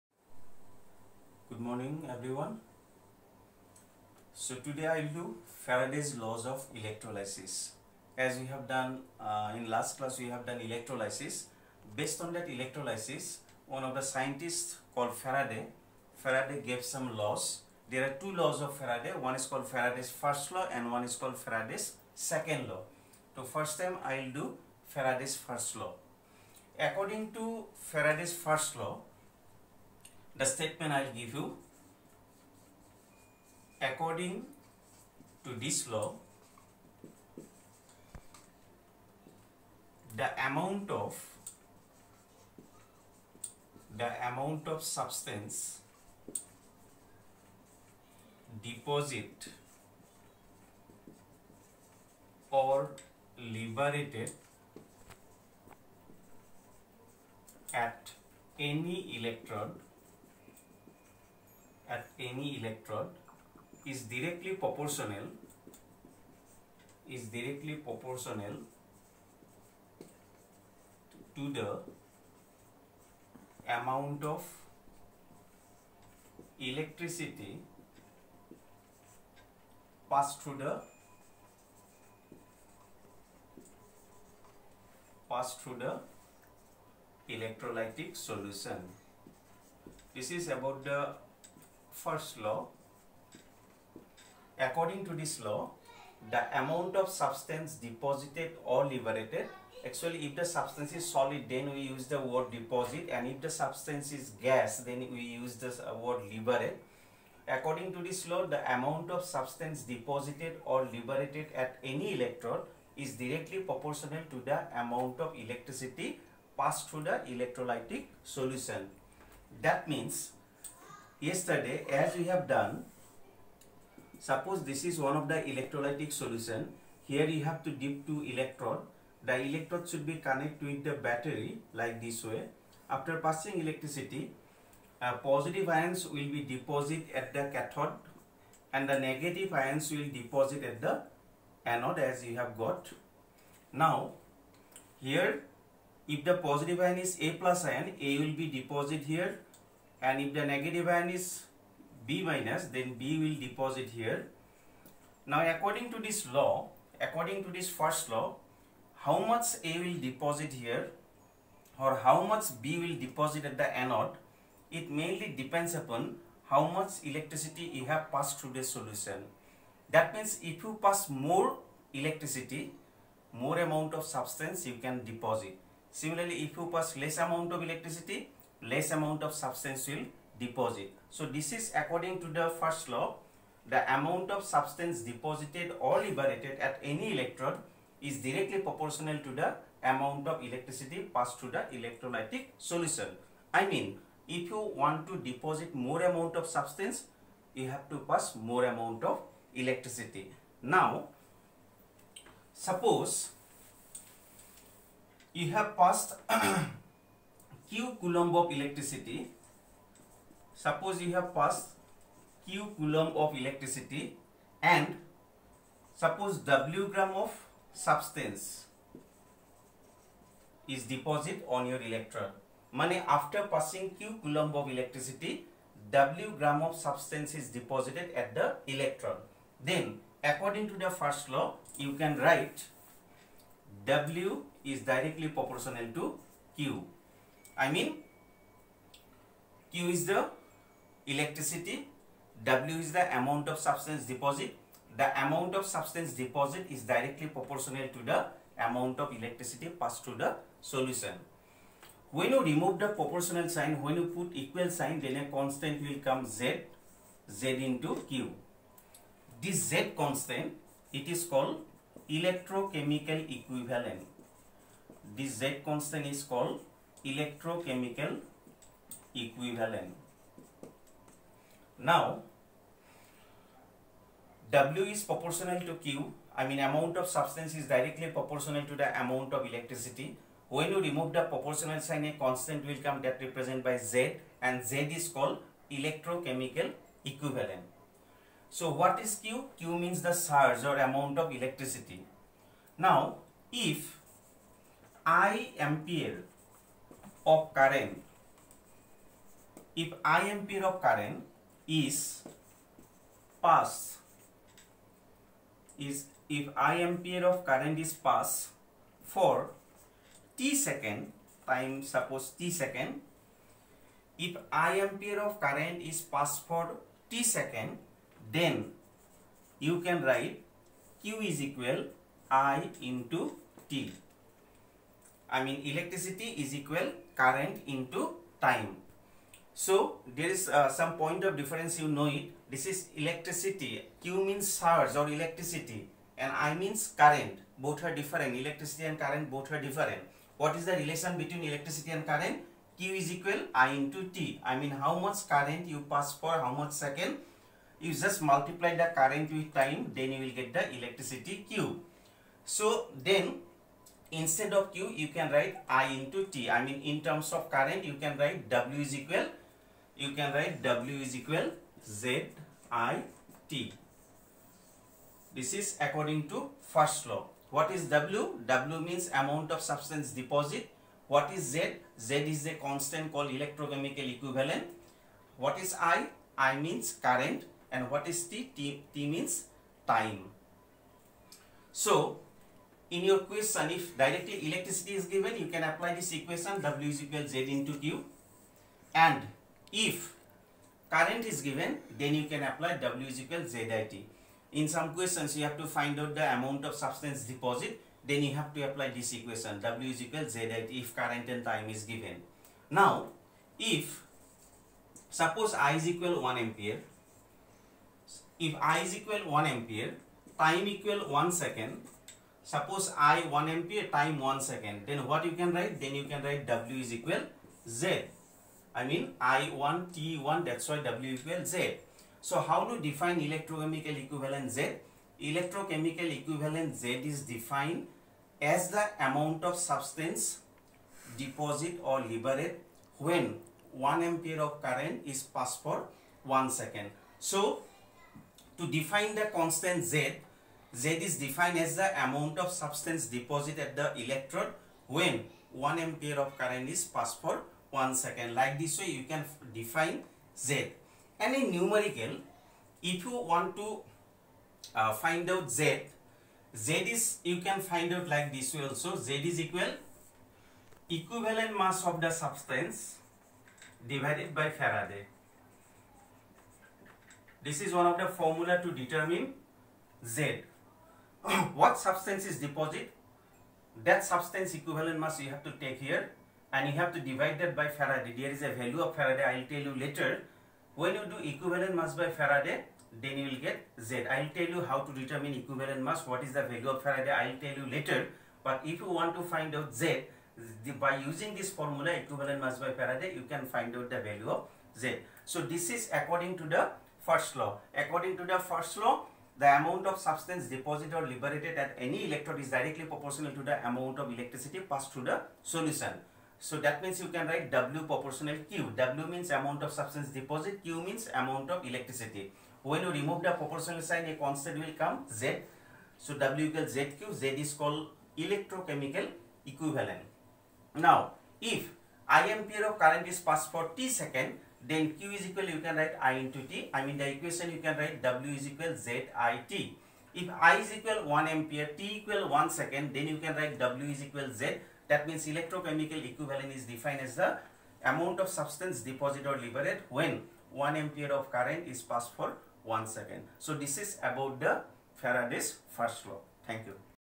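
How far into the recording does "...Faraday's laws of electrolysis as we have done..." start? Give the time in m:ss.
0:05.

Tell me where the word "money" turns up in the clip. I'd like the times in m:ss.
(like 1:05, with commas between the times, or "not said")
3:42.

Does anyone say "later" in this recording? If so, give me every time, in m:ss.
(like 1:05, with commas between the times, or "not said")
7:59, 8:07.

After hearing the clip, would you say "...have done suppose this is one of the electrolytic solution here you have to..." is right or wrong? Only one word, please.
right.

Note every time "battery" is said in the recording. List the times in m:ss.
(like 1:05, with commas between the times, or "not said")
2:11.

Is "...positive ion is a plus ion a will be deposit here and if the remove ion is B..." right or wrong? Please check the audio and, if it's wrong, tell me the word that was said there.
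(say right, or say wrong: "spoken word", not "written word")
wrong: "negative", not "remove".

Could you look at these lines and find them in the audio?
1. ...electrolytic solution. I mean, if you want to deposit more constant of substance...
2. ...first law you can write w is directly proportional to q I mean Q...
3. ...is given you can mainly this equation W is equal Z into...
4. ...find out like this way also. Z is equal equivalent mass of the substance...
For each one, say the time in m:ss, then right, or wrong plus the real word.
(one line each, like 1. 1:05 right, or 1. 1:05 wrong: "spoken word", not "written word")
1. 3:11 wrong: "amount", not "constant"
2. 3:51 right
3. 6:25 wrong: "apply", not "mainly"
4. 7:37 right.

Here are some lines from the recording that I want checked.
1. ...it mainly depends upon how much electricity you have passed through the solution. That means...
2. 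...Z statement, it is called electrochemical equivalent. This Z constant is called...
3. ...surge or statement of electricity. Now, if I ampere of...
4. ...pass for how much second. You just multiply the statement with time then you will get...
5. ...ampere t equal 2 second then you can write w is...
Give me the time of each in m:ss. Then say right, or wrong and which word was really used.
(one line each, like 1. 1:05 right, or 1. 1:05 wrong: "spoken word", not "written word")
1. 2:44 right
2. 4:19 wrong: "constant", not "statement"
3. 4:50 wrong: "amount", not "statement"
4. 5:45 wrong: "current", not "statement"
5. 8:51 wrong: "1", not "2".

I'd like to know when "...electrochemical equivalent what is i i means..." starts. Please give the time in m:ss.
6:13.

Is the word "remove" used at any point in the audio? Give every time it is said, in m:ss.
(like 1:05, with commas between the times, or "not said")
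4:12, 4:40, 8:32.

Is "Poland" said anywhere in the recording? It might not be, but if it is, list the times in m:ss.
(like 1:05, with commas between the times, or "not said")
not said.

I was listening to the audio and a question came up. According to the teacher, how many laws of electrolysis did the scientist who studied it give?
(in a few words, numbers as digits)
2.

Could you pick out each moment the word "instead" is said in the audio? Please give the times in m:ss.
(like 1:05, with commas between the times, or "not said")
5:54.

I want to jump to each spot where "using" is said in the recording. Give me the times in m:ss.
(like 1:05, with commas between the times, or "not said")
8:10.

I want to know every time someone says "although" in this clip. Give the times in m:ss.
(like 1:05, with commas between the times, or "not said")
not said.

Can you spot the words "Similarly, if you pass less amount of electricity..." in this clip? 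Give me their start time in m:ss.
2:55.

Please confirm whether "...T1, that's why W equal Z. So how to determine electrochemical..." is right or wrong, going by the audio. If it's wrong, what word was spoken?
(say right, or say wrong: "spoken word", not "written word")
wrong: "define", not "determine".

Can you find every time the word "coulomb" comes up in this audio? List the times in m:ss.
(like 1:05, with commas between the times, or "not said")
3:27, 3:32, 3:44.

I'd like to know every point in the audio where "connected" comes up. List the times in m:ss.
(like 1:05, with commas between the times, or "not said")
2:10.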